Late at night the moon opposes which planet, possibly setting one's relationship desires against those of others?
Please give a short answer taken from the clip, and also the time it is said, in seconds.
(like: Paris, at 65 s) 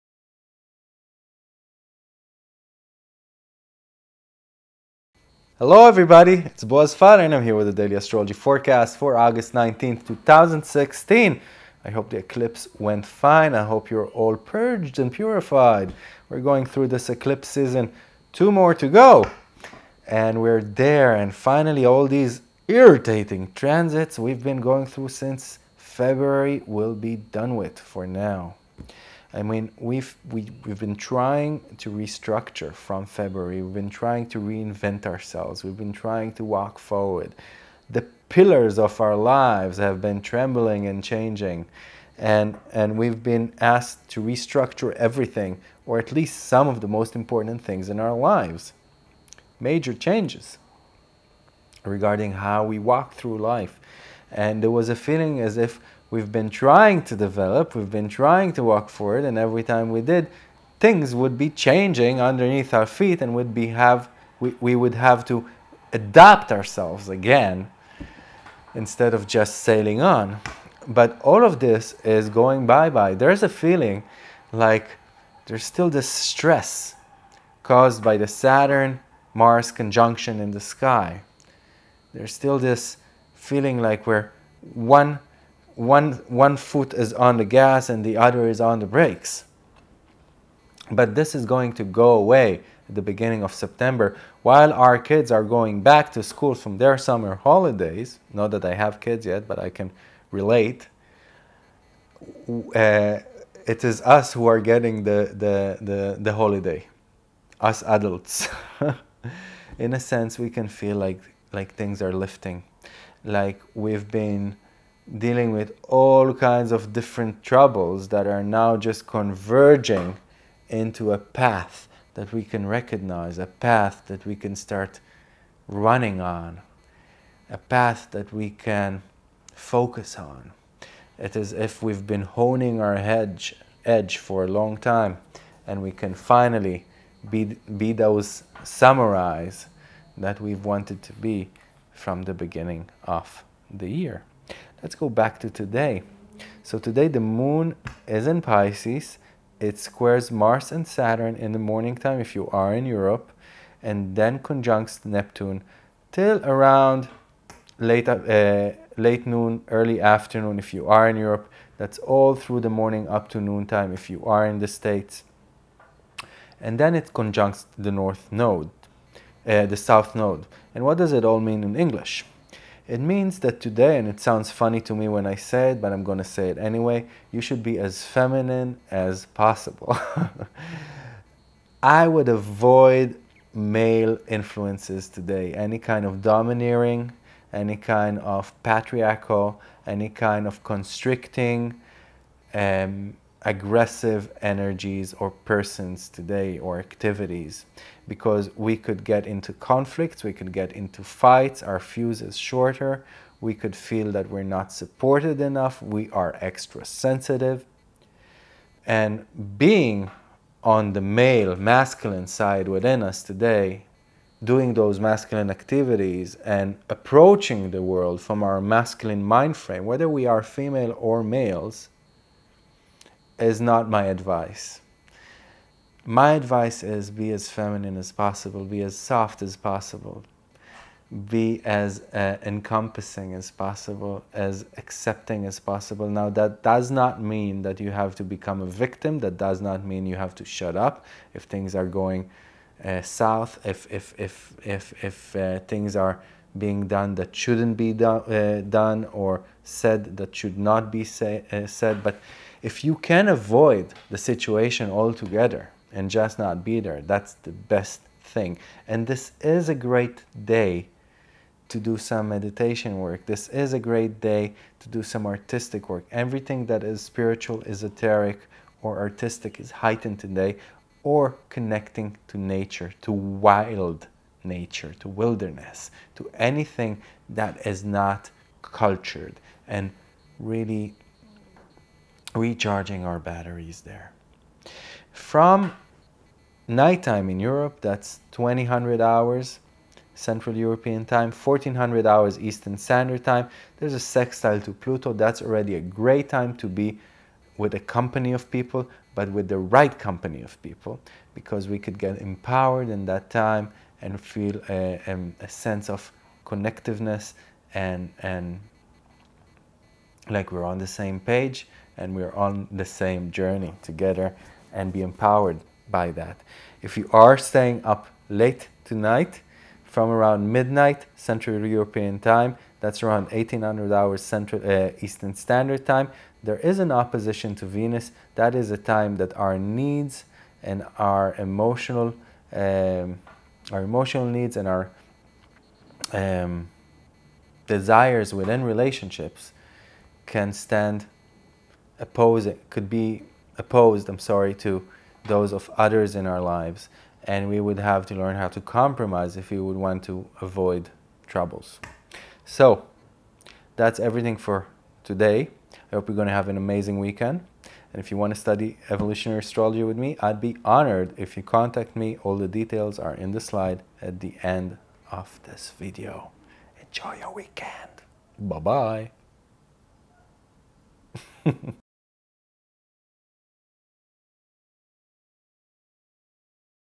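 Venus, at 327 s.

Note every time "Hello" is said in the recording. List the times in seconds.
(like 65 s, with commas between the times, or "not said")
5 s.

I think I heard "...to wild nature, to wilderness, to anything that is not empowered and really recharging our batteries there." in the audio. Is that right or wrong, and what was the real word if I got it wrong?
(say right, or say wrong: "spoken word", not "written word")
wrong: "cultured", not "empowered".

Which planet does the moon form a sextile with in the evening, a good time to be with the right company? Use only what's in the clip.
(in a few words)
Pluto.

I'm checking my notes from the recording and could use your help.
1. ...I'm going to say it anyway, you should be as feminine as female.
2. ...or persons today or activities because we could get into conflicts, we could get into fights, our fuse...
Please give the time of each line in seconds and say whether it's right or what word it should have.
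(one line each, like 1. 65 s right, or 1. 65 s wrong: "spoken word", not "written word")
1. 175 s wrong: "possible", not "female"
2. 195 s right.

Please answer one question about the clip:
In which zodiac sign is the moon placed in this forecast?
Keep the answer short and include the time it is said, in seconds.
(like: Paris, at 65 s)
Pisces, at 148 s.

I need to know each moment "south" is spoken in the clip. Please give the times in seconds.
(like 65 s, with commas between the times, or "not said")
169 s, 243 s.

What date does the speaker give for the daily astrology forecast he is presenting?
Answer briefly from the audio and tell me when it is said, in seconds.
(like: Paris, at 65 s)
August 19th, 2016, at 9 s.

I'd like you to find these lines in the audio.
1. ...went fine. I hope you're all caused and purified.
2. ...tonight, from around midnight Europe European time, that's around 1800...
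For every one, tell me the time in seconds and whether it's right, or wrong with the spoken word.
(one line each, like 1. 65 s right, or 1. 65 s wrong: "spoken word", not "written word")
1. 12 s wrong: "purged", not "caused"
2. 318 s wrong: "Central", not "Europe".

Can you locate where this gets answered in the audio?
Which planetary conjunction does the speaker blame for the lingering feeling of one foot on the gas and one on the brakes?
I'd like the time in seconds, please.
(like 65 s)
78 s.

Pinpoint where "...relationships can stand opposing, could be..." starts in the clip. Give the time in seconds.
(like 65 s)
338 s.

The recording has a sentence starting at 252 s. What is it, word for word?
But if you can avoid the situation altogether and just not be there, that's the best thing.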